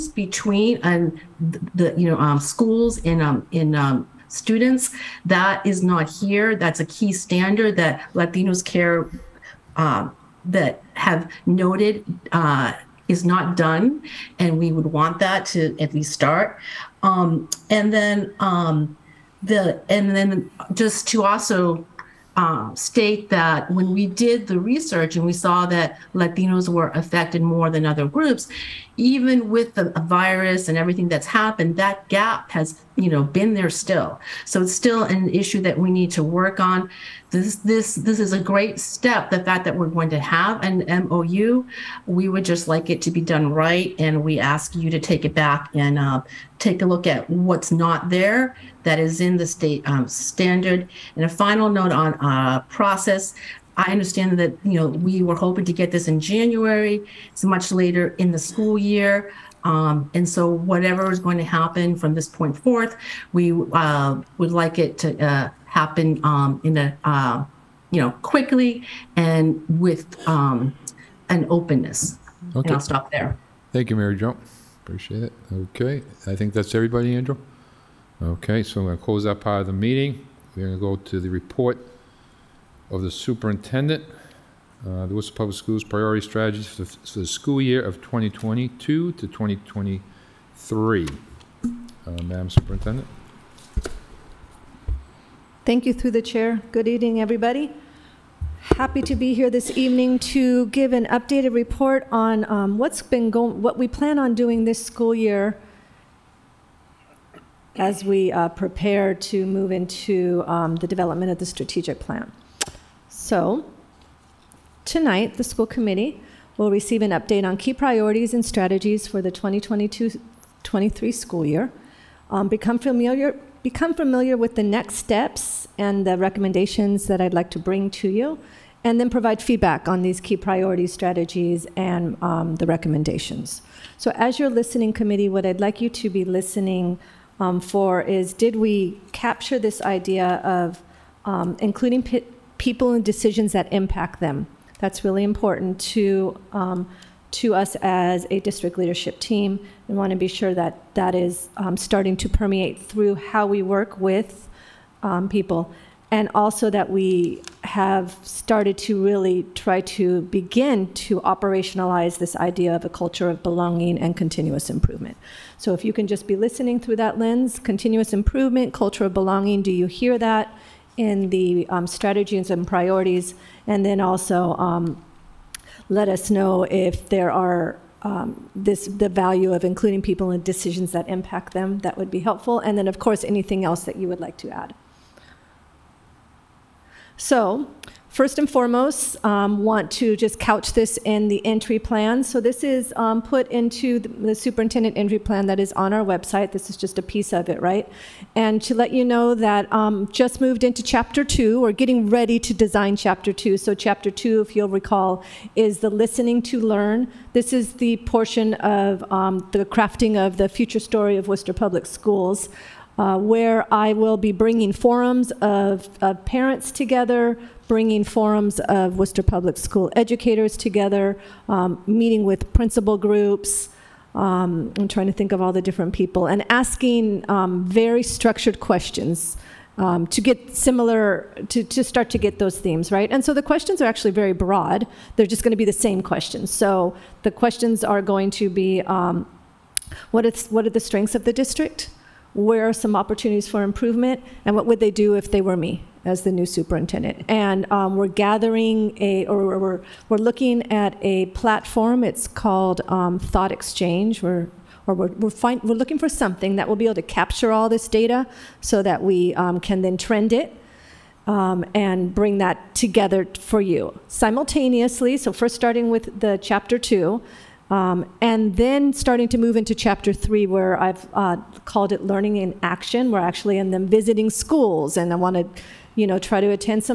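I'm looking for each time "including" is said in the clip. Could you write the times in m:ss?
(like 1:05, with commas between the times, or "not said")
2:21, 2:59.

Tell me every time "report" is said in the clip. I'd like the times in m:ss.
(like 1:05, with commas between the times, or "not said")
1:21, 1:41.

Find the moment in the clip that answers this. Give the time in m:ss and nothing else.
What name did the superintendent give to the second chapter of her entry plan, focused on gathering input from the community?
3:25.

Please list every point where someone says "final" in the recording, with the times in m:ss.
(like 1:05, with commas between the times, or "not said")
0:51.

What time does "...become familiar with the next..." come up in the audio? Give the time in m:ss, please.
2:03.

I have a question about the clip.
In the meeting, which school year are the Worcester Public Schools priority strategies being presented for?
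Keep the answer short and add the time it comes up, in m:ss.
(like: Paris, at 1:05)
2022 to 2023, at 1:27.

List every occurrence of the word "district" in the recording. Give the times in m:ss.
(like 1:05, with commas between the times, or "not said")
2:28, 4:01.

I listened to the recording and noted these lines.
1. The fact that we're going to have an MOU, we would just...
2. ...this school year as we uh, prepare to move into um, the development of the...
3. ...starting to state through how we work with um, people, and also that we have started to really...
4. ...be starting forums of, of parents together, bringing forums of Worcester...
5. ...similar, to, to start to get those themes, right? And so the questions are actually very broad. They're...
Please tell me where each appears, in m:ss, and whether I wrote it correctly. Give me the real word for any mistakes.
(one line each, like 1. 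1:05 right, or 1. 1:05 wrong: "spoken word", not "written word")
1. 0:39 right
2. 1:44 right
3. 2:31 wrong: "permeate", not "state"
4. 3:34 wrong: "bringing", not "starting"
5. 3:50 right.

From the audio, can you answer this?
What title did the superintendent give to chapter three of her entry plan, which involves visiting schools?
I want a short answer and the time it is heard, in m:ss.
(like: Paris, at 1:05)
learning in action, at 4:32.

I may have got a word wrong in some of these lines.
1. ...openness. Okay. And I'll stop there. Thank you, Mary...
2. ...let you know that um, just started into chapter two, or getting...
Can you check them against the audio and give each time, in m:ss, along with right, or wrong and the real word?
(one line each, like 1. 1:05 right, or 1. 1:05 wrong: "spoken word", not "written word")
1. 1:11 right
2. 3:18 wrong: "moved", not "started".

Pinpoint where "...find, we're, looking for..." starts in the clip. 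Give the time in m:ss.
4:15.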